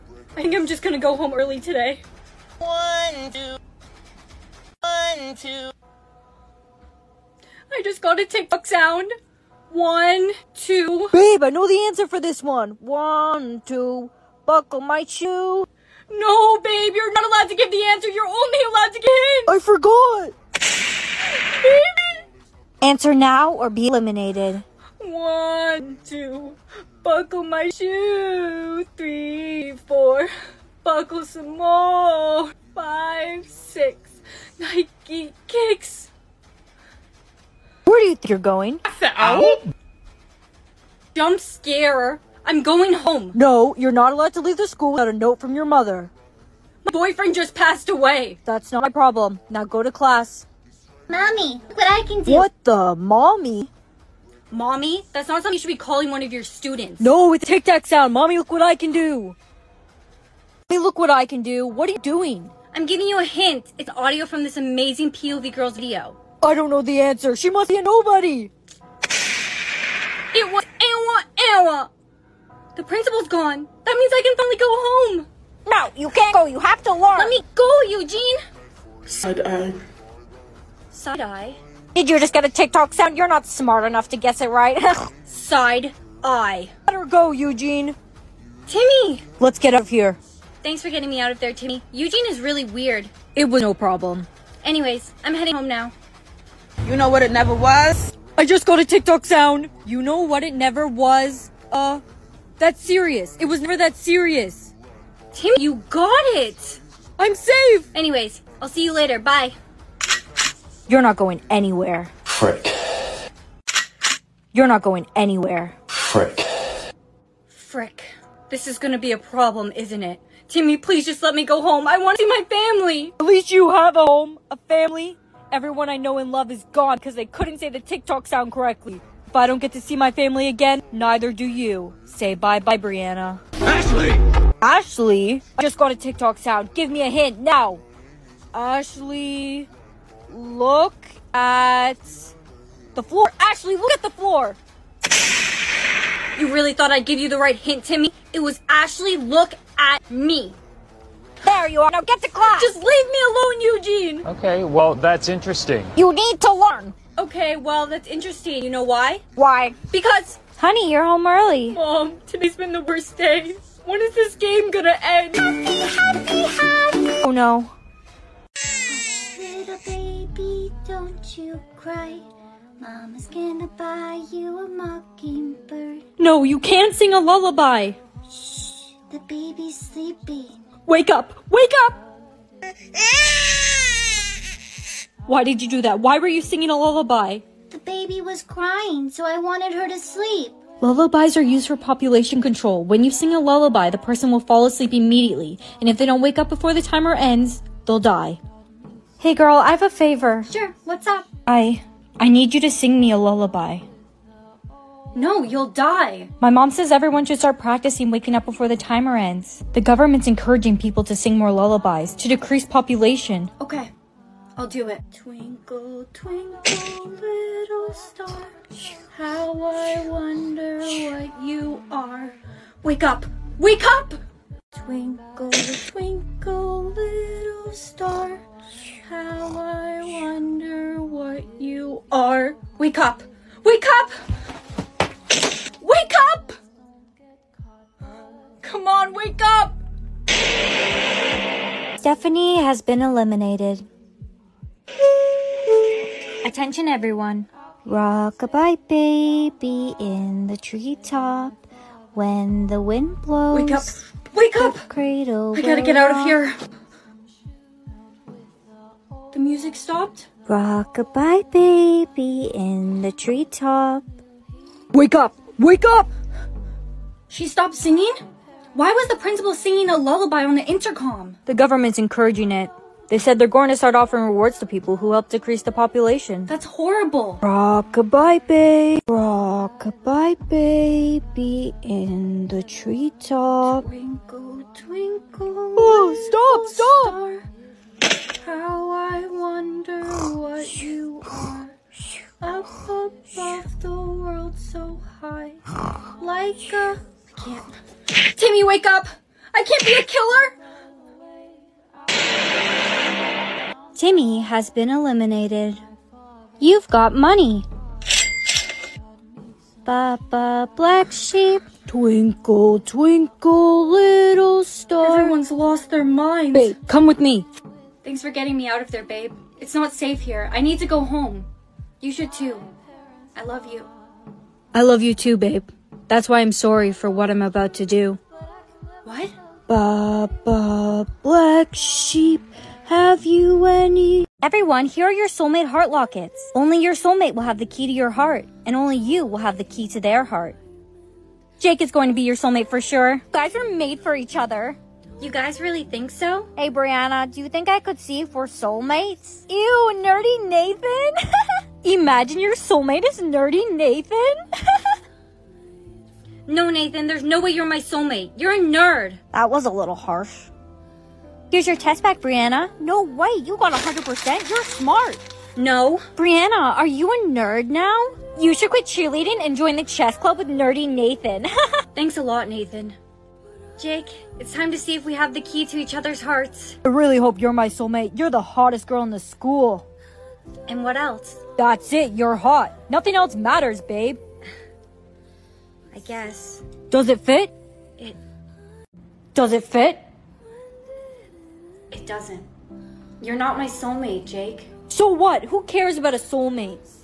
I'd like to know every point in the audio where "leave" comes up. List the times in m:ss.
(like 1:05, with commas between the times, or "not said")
0:44, 2:32.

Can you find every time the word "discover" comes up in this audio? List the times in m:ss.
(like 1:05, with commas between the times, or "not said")
not said.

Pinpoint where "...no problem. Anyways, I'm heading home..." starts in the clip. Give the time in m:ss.
1:33.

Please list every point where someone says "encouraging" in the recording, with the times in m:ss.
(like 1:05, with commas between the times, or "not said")
3:30, 4:31.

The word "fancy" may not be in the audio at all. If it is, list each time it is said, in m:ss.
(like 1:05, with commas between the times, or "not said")
not said.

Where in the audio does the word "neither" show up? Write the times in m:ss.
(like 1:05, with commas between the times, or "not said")
2:10.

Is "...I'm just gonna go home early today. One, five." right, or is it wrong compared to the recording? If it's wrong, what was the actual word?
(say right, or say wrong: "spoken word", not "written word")
wrong: "two", not "five".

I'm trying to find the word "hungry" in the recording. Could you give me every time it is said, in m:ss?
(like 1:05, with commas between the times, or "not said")
not said.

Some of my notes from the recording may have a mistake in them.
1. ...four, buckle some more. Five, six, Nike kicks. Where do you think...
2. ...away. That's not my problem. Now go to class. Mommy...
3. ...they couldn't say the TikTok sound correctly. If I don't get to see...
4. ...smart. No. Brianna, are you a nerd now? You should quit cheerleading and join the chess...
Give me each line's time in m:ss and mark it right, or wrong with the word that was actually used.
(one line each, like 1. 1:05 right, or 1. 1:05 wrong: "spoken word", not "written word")
1. 0:29 right
2. 0:47 right
3. 2:07 right
4. 6:04 right.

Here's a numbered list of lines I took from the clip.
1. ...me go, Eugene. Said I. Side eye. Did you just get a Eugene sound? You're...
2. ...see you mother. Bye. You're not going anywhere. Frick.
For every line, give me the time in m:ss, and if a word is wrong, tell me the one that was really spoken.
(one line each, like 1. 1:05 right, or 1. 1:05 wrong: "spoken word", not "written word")
1. 1:17 wrong: "TikTok", not "Eugene"
2. 1:48 wrong: "later", not "mother".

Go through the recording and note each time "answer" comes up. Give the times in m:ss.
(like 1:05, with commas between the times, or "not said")
0:11, 0:17, 0:22, 1:07.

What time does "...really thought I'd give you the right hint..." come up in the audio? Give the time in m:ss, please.
2:26.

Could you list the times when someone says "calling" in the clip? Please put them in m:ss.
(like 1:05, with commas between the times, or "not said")
0:55.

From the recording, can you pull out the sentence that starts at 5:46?
Hey, Brianna, do you think I could see if we're soulmates?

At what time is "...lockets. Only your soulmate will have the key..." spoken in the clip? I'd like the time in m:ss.
5:35.